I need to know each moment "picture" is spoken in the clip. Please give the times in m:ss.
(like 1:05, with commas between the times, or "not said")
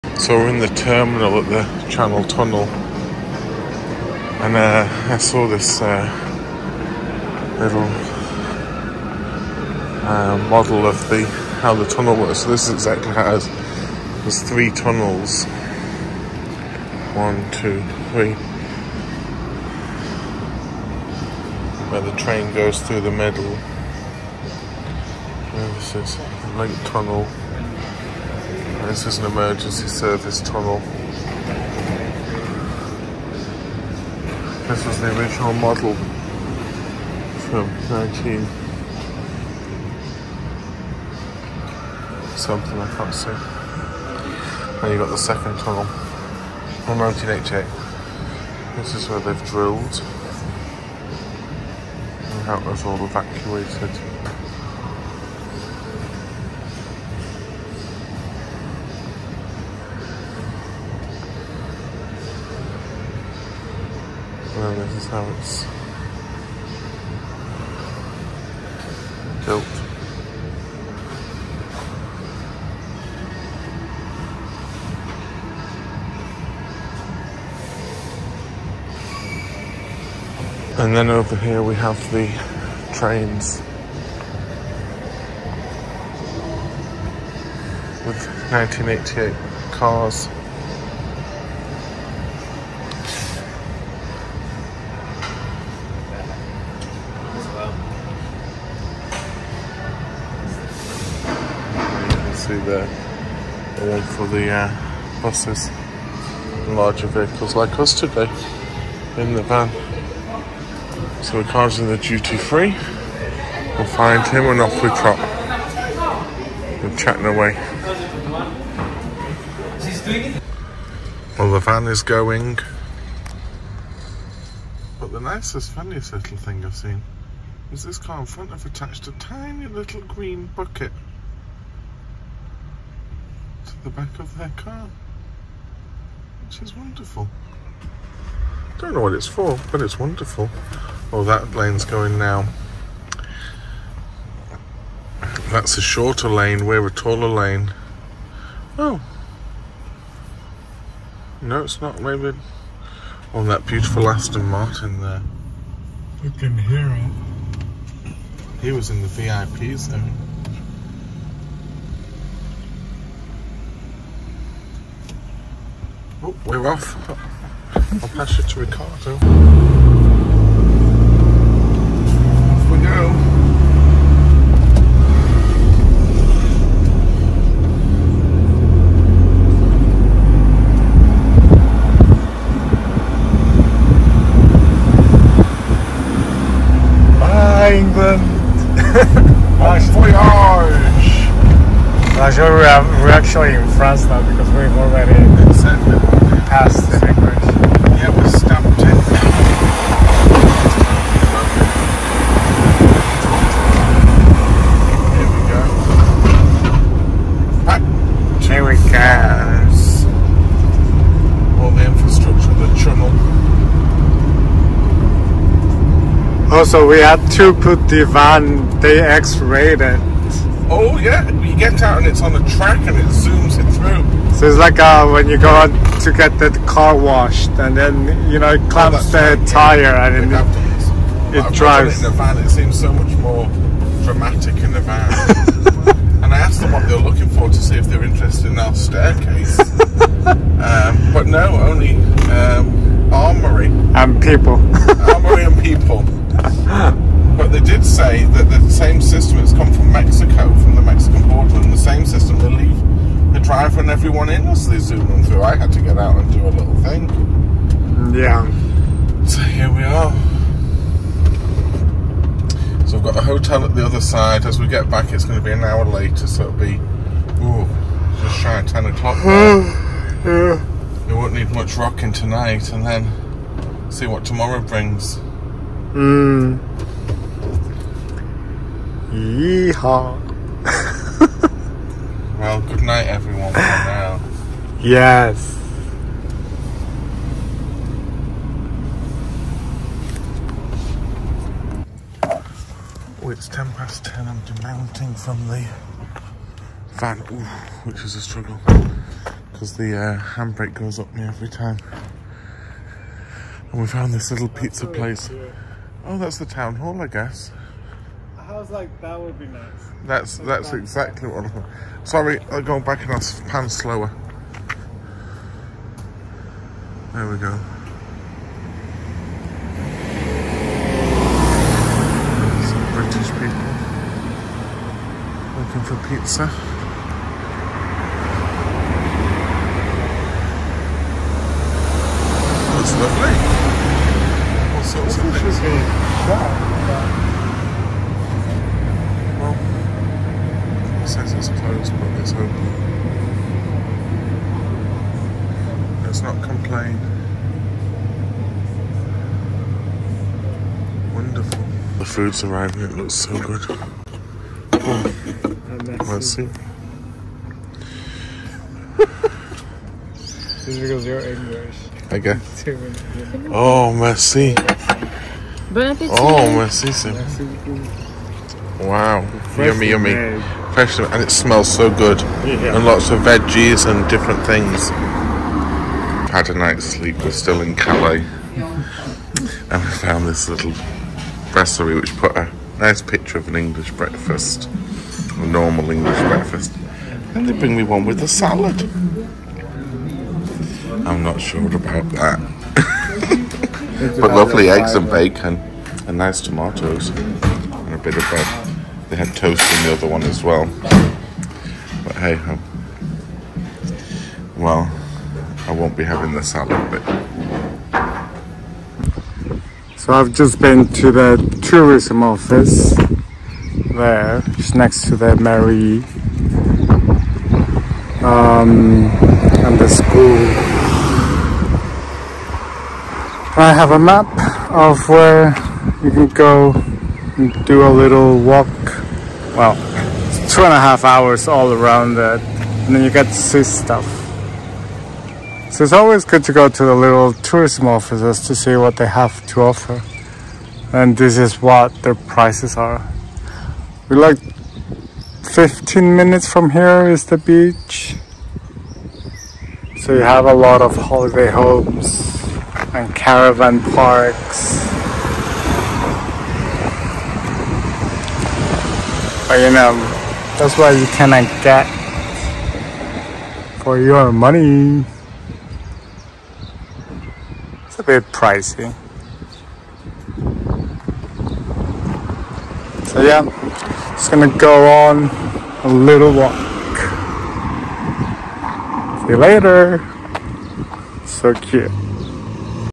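6:23.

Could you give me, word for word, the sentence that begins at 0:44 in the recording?
And you got the second tunnel from 1988.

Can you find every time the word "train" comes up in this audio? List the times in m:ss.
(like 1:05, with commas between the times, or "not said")
0:22, 1:22.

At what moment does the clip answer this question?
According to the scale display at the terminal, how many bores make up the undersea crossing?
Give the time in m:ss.
0:14.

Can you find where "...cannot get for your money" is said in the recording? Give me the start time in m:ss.
7:41.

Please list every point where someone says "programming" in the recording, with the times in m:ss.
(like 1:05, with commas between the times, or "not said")
not said.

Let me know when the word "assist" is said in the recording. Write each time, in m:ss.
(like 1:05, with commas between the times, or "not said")
not said.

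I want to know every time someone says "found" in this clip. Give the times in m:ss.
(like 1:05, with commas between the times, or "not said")
5:03, 6:19.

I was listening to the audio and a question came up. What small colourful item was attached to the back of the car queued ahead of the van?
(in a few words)
green bucket.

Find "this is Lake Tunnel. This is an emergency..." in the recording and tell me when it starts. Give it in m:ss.
0:25.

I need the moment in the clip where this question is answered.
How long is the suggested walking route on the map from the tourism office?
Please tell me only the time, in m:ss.
7:10.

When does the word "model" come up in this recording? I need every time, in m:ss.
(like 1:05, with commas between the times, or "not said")
0:10, 0:35.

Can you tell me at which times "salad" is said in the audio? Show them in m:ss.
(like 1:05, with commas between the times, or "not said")
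6:28, 6:46.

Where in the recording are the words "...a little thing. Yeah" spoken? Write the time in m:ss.
4:16.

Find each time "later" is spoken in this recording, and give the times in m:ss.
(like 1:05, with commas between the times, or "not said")
4:25, 7:59.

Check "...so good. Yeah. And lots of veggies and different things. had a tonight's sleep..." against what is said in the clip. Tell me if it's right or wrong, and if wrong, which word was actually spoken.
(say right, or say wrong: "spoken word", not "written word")
wrong: "night", not "tonight".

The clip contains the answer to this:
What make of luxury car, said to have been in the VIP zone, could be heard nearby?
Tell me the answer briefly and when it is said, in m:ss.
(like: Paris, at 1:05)
Aston Martin, at 2:34.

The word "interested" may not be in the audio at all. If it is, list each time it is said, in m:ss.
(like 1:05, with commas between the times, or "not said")
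3:58.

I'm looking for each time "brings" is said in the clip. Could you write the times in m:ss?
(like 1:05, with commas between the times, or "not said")
4:34, 6:27.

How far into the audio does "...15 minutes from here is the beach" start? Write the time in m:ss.
7:25.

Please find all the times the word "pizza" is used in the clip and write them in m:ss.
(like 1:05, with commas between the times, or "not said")
5:04, 5:26.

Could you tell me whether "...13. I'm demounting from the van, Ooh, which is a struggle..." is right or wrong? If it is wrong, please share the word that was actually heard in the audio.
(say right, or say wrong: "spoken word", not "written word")
wrong: "10", not "13".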